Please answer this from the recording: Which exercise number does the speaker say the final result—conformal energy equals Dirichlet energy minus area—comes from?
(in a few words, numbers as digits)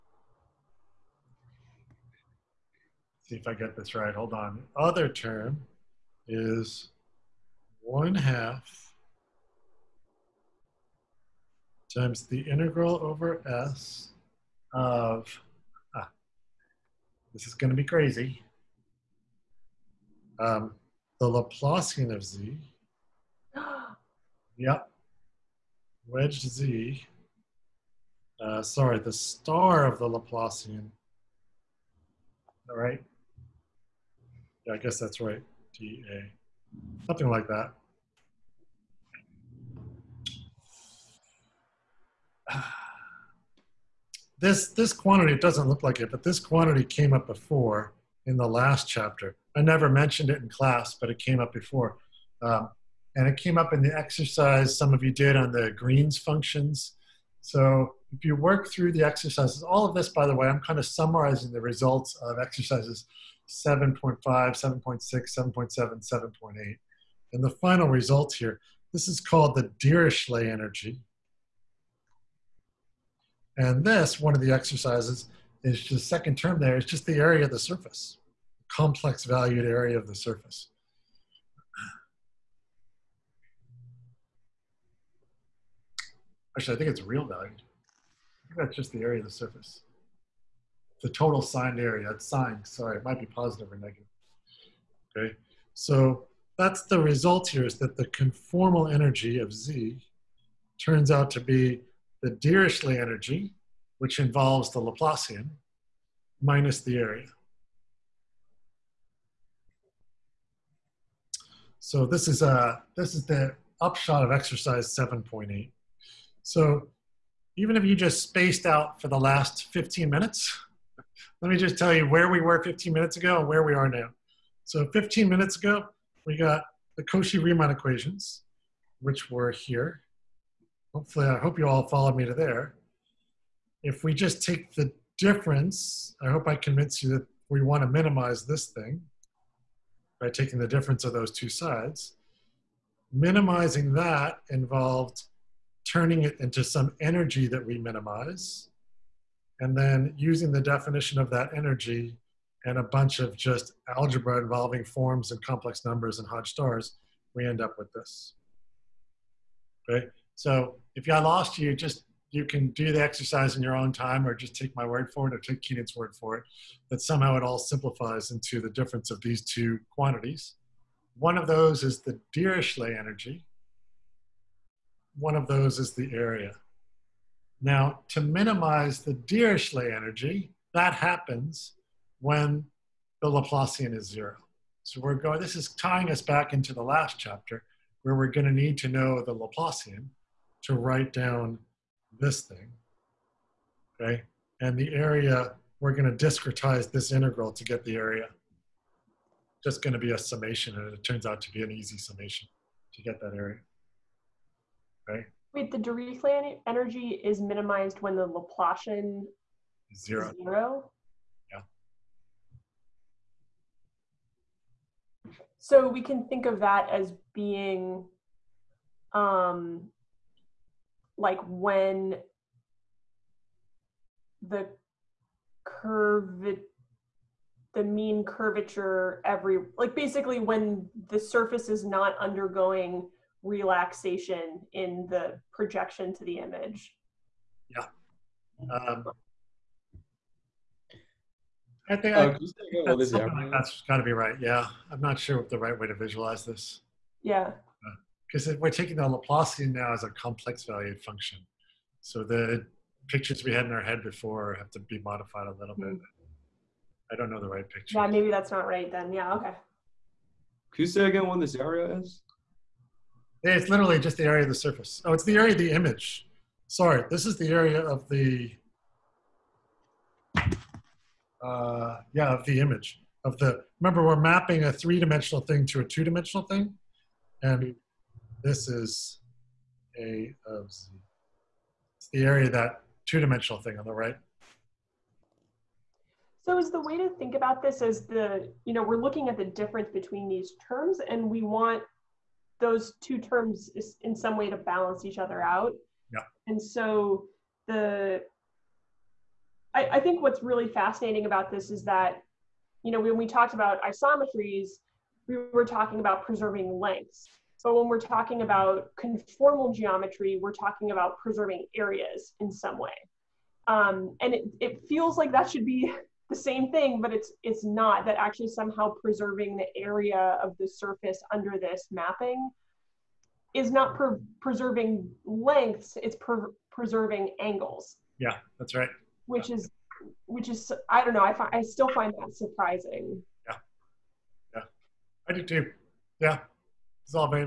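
7.8.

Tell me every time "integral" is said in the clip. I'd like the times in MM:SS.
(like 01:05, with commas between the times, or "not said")
00:12, 03:17.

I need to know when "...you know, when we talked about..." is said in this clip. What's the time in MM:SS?
05:02.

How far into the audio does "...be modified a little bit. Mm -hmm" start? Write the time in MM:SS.
04:14.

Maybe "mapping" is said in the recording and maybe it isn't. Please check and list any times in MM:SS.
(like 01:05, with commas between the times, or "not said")
04:34, 05:21.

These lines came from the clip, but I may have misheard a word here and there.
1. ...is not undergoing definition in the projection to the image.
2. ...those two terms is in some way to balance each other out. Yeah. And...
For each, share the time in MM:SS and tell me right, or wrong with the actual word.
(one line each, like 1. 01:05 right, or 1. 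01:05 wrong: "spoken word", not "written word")
1. 03:51 wrong: "relaxation", not "definition"
2. 04:52 right.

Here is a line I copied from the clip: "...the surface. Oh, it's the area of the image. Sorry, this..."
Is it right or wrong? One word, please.
right.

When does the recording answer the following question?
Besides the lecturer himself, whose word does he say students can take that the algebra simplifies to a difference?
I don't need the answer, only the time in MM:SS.
02:45.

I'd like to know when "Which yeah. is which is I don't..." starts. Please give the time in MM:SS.
05:29.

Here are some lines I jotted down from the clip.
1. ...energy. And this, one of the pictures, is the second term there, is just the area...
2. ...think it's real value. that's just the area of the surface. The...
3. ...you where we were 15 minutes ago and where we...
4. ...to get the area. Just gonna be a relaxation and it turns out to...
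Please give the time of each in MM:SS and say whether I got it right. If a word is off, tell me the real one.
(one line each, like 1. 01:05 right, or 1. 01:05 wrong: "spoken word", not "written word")
1. 01:10 wrong: "exercises", not "pictures"
2. 01:26 right
3. 02:01 right
4. 03:17 wrong: "summation", not "relaxation".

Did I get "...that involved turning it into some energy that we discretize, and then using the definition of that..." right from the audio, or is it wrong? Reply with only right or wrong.
wrong.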